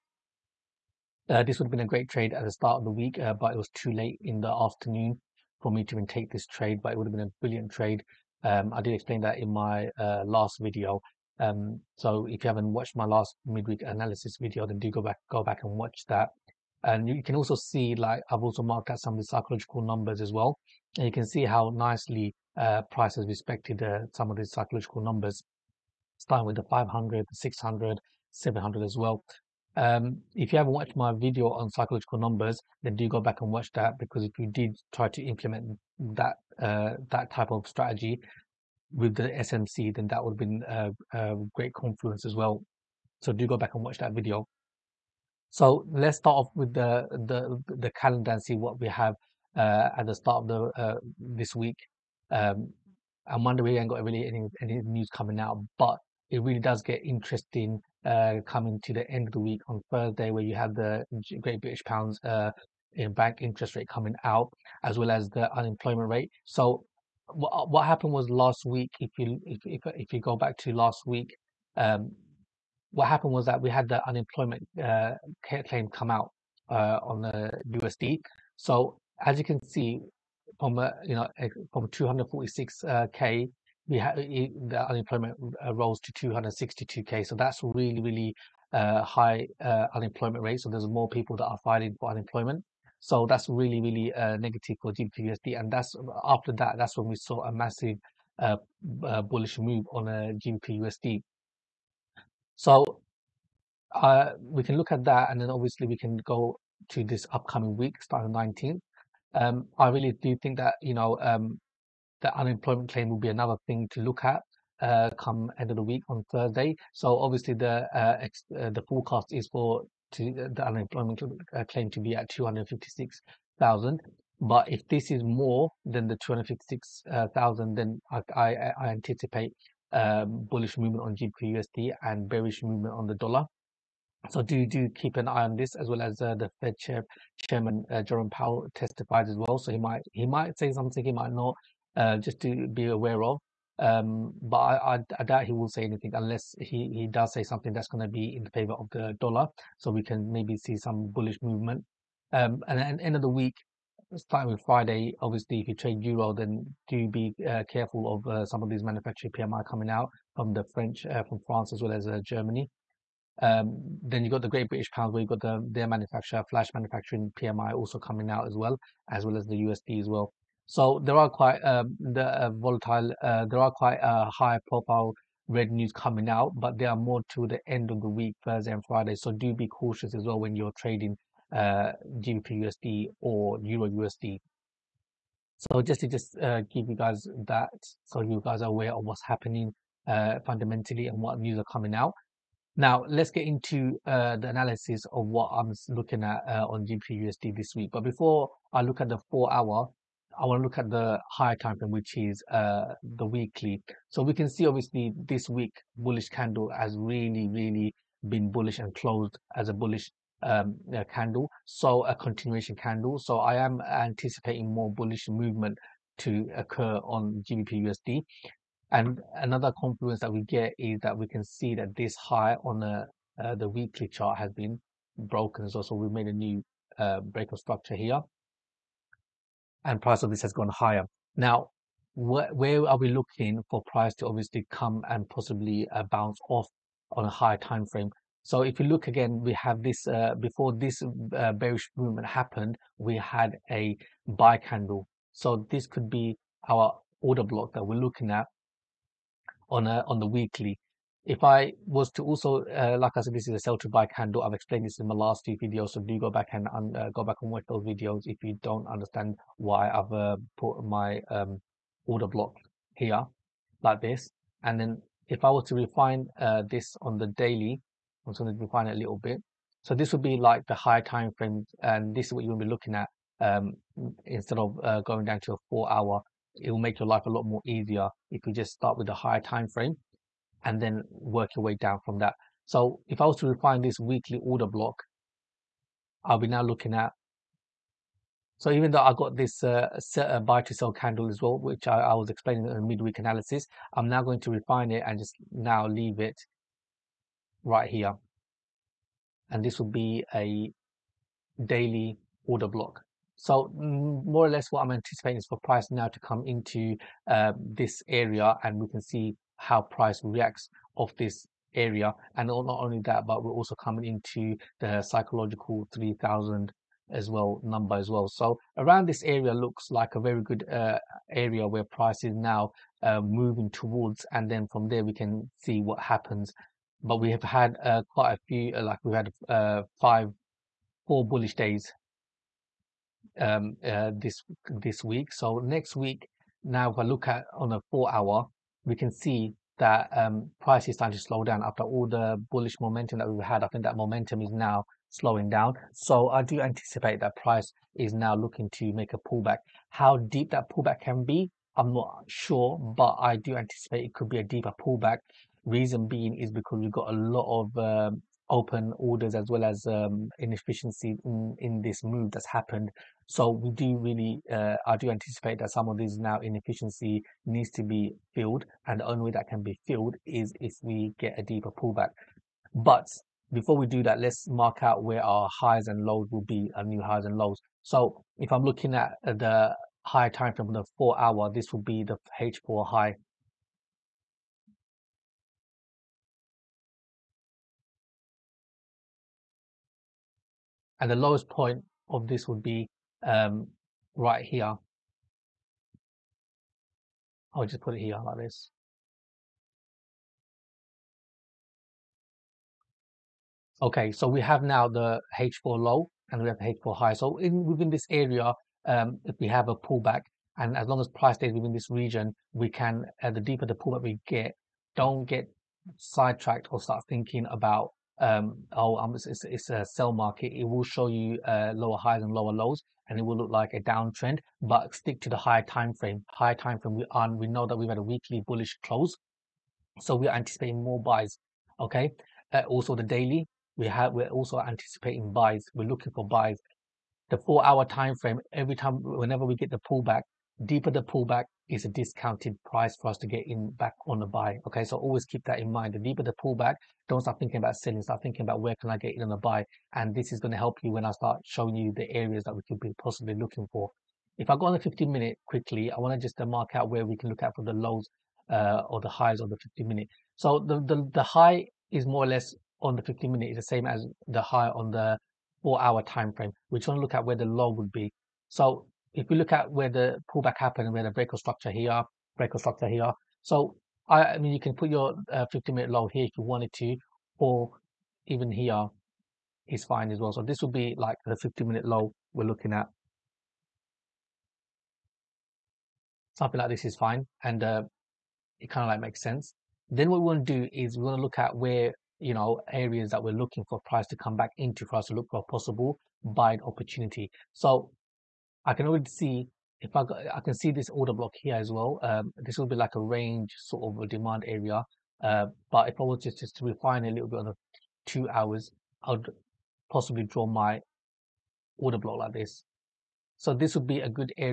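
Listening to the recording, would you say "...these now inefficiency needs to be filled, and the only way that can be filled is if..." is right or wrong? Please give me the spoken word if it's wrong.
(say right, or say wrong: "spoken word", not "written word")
right.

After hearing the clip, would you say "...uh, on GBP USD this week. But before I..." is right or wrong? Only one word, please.
right.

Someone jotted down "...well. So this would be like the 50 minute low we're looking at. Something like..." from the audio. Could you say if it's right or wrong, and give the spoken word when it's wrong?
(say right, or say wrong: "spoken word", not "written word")
right.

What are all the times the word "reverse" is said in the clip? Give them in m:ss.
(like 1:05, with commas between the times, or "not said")
not said.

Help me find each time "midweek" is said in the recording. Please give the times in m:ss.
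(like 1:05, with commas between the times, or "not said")
0:13, 4:52.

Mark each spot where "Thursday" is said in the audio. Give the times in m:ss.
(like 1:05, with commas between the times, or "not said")
0:59, 1:56, 2:58.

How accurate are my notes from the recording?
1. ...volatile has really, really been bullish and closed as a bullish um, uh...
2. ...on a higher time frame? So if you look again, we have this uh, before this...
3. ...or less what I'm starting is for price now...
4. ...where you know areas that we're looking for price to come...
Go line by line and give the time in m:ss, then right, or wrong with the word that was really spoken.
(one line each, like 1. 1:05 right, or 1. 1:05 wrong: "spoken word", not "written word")
1. 3:26 wrong: "candle", not "volatile"
2. 3:57 right
3. 5:04 wrong: "anticipating", not "starting"
4. 8:11 right.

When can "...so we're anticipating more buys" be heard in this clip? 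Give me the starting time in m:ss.
7:09.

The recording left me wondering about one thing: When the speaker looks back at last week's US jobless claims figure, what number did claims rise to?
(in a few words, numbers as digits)
262k.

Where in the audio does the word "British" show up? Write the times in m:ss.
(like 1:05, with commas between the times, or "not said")
1:01, 2:44.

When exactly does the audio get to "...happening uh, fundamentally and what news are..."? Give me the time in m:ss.
3:09.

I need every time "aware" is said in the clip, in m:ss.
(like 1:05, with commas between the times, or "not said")
2:22, 3:08.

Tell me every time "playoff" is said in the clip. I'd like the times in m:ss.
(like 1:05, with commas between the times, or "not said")
not said.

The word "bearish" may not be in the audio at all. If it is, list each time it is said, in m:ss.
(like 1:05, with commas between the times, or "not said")
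2:12, 4:01.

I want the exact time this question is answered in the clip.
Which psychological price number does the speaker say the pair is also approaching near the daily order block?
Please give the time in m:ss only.
5:15.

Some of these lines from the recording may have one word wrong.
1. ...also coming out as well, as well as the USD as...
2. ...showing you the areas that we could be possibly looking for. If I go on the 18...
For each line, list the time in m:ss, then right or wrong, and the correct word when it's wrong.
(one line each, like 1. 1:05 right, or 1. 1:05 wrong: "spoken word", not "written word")
1. 2:47 right
2. 7:31 wrong: "15", not "18".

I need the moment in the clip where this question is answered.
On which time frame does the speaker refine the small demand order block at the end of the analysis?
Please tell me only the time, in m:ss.
8:28.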